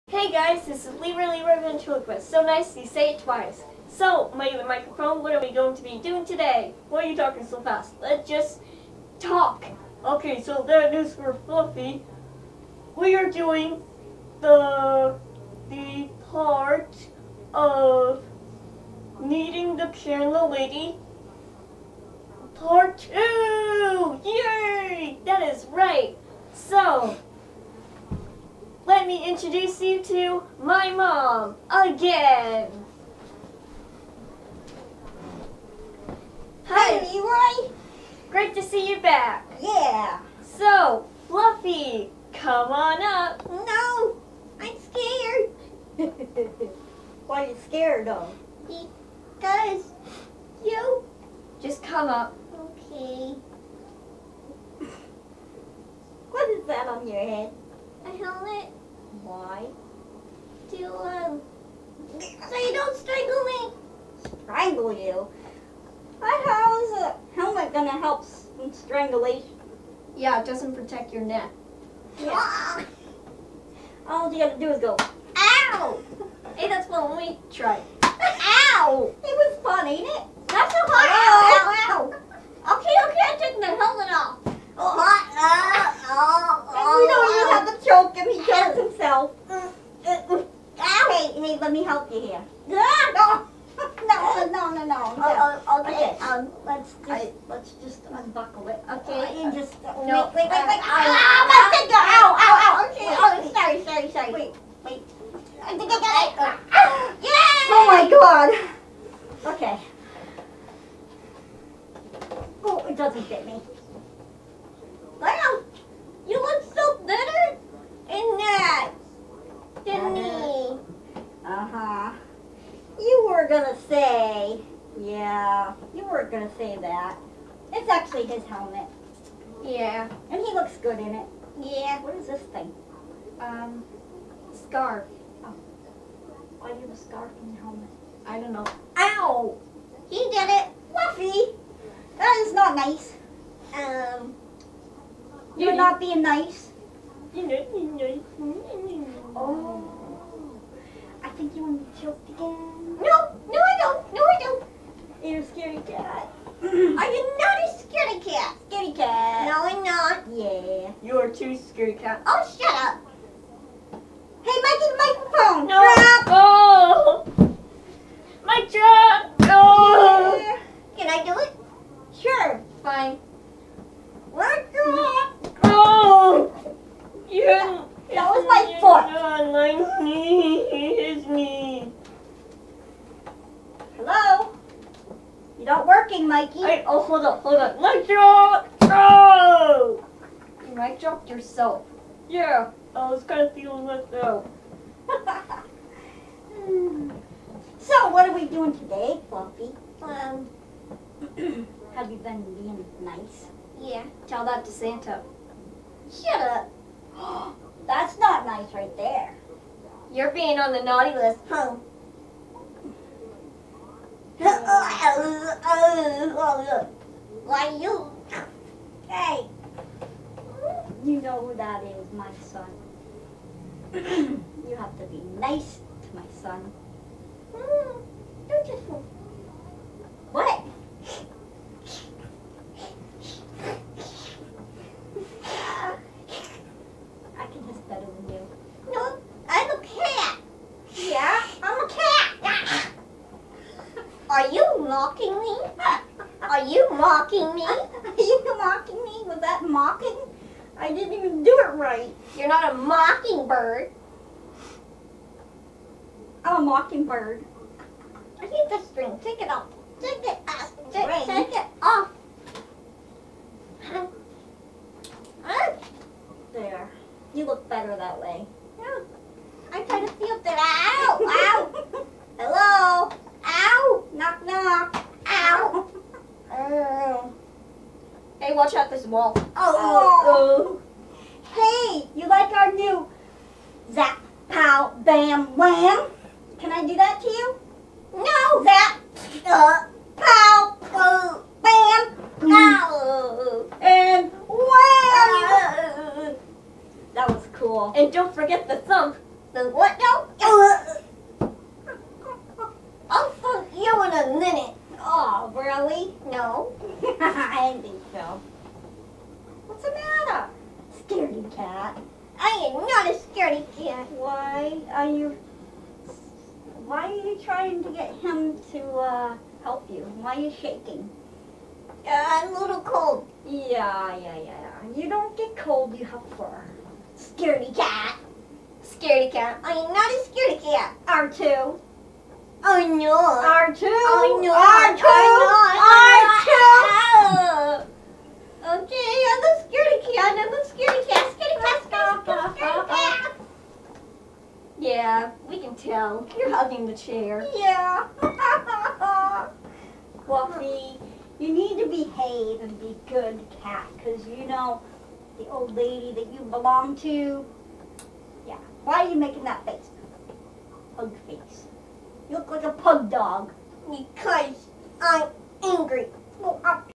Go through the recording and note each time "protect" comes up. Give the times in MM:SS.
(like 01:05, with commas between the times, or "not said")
01:10.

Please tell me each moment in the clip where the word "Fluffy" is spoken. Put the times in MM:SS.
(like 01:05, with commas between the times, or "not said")
00:11, 00:41, 02:20, 03:19, 05:50.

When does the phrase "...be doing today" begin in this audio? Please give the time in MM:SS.
00:05.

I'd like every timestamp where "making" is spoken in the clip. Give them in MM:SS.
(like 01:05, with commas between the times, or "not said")
05:59.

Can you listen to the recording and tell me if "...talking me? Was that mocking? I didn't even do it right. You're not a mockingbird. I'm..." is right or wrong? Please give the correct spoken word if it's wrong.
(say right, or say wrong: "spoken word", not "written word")
wrong: "mocking", not "talking".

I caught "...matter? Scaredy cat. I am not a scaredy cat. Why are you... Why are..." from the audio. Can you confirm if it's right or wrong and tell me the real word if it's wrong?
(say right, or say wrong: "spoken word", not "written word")
right.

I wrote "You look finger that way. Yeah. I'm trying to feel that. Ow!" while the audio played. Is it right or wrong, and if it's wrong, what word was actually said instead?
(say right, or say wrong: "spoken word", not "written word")
wrong: "better", not "finger".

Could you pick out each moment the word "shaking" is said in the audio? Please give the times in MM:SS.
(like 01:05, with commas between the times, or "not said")
05:20.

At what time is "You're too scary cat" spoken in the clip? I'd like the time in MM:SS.
02:41.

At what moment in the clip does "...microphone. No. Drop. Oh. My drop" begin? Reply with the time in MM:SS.
02:44.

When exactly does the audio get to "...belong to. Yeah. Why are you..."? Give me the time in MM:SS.
05:56.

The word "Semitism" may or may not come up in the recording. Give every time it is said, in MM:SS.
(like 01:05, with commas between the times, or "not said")
not said.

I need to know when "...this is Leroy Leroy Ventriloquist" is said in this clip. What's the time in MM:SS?
00:00.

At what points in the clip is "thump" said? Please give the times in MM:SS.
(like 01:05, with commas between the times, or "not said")
04:58, 05:03.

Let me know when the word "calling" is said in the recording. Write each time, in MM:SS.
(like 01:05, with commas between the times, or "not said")
not said.